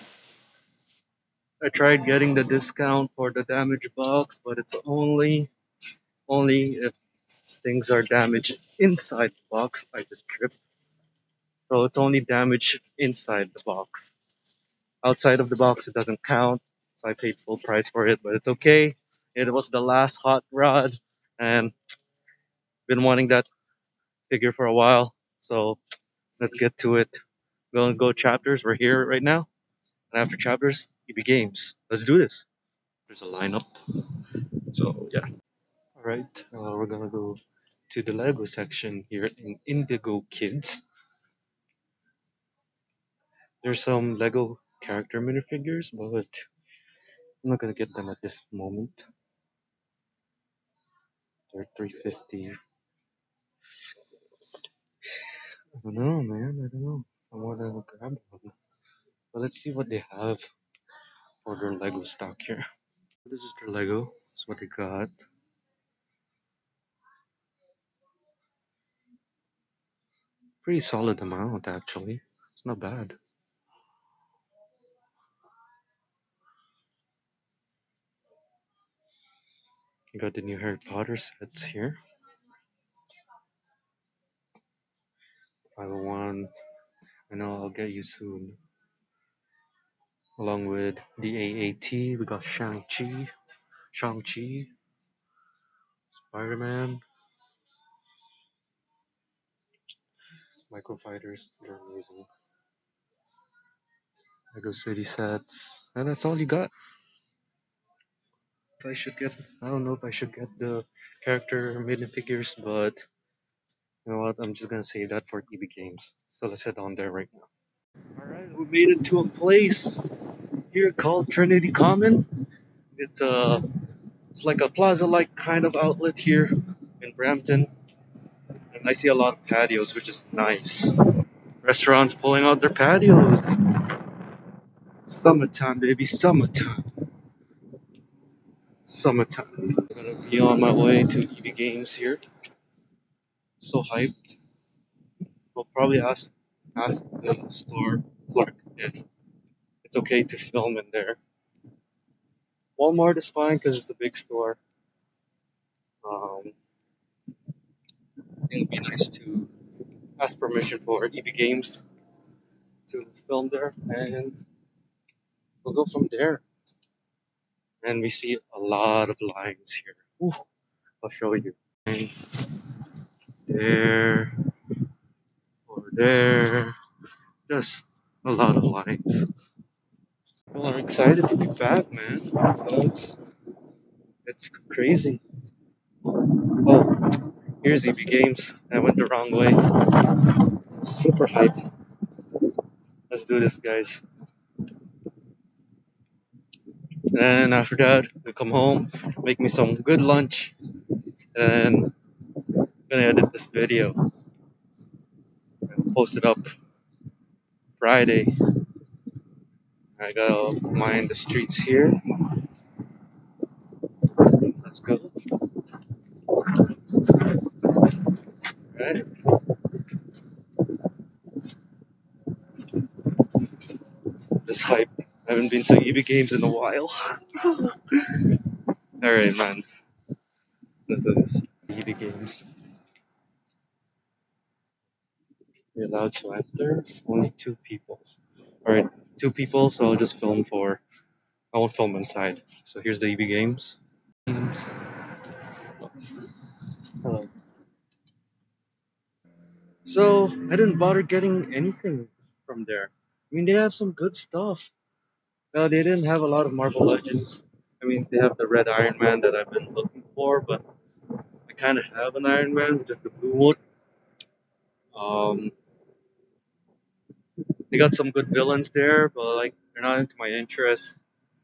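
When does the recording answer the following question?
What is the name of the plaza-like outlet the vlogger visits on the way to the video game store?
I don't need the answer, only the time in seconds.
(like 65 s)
121 s.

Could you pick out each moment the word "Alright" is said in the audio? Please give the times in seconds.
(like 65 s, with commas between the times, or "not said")
118 s, 216 s, 229 s.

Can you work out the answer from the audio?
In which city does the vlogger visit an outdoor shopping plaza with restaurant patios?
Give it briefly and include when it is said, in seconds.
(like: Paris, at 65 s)
Brampton, at 127 s.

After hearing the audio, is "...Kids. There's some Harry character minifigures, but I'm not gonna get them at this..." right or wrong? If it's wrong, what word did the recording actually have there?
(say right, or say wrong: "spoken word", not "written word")
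wrong: "Lego", not "Harry".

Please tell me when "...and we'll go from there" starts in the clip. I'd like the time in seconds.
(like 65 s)
163 s.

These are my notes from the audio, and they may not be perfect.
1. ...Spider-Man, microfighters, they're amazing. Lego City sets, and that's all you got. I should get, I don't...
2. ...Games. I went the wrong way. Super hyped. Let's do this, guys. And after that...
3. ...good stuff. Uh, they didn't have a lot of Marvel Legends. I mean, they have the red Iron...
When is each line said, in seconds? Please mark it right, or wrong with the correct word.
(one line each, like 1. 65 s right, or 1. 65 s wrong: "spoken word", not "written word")
1. 96 s right
2. 187 s right
3. 253 s right.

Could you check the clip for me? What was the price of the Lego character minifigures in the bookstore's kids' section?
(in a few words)
350.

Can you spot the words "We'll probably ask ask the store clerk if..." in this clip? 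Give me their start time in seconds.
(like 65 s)
145 s.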